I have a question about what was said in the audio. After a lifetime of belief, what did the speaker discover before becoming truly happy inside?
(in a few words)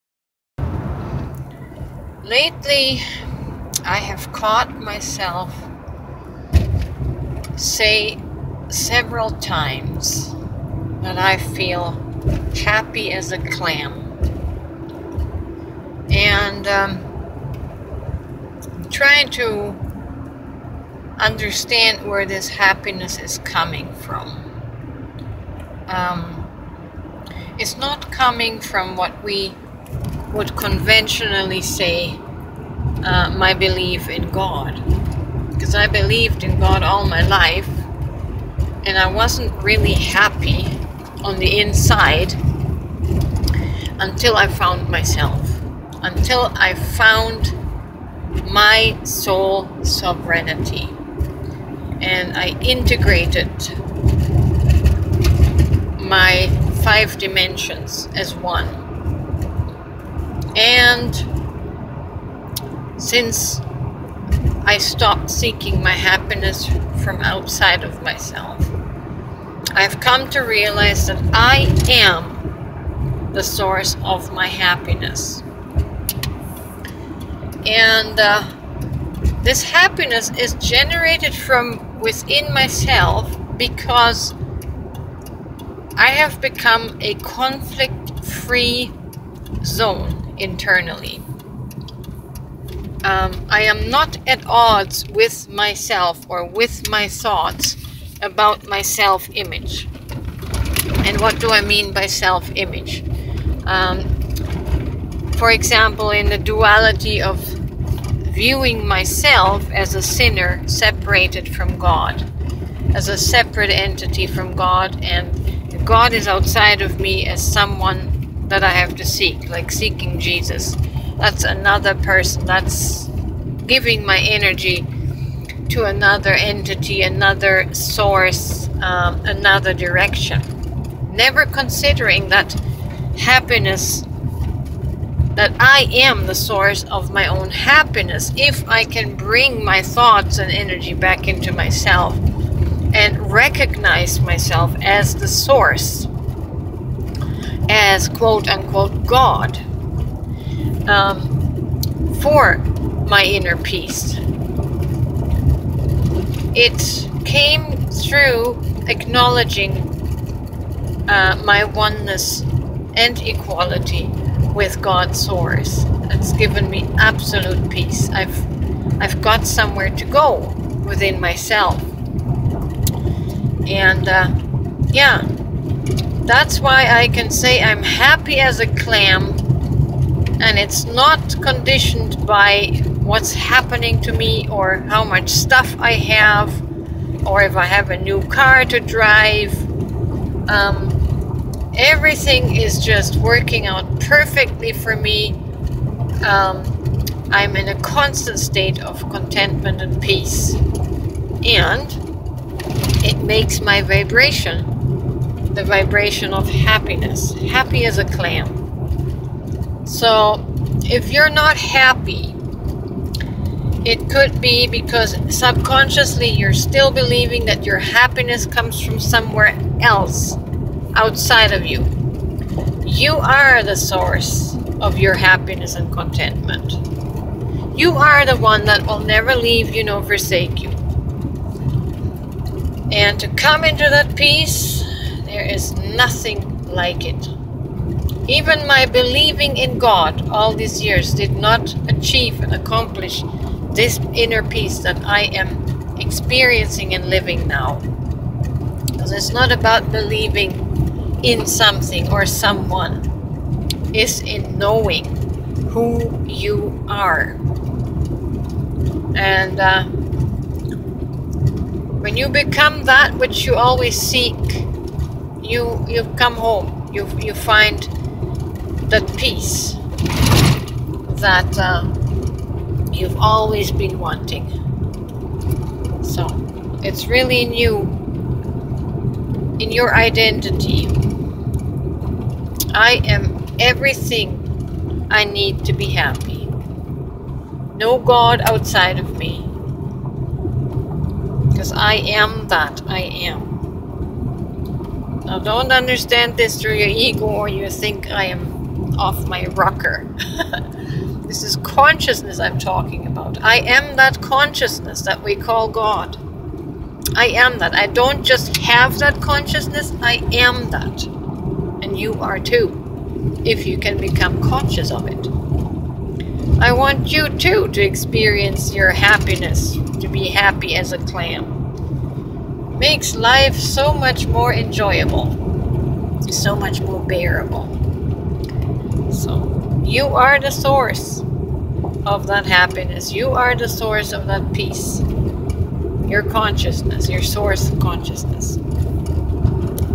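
soul sovereignty.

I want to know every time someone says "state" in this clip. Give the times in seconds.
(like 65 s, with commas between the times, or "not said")
198 s.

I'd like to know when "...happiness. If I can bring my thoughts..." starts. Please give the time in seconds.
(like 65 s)
137 s.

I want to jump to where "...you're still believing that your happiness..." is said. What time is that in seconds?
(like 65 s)
216 s.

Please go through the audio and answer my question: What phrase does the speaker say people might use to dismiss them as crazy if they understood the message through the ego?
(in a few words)
off my rocker.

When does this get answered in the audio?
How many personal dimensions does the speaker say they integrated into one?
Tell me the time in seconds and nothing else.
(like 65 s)
56 s.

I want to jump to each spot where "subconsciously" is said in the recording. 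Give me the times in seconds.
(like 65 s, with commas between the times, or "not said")
215 s.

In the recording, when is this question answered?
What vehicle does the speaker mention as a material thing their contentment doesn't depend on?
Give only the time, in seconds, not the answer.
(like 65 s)
187 s.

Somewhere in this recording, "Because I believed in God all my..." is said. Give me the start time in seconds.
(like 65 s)
35 s.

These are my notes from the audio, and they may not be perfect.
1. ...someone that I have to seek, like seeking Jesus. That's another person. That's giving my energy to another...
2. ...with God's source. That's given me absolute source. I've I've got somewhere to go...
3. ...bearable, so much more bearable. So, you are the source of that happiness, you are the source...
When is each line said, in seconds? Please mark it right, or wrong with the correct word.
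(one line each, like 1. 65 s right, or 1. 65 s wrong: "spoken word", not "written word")
1. 117 s right
2. 164 s wrong: "peace", not "source"
3. 324 s wrong: "enjoyable", not "bearable".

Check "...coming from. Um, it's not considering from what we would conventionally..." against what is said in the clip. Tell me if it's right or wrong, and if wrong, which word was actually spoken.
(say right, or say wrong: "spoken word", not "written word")
wrong: "coming", not "considering".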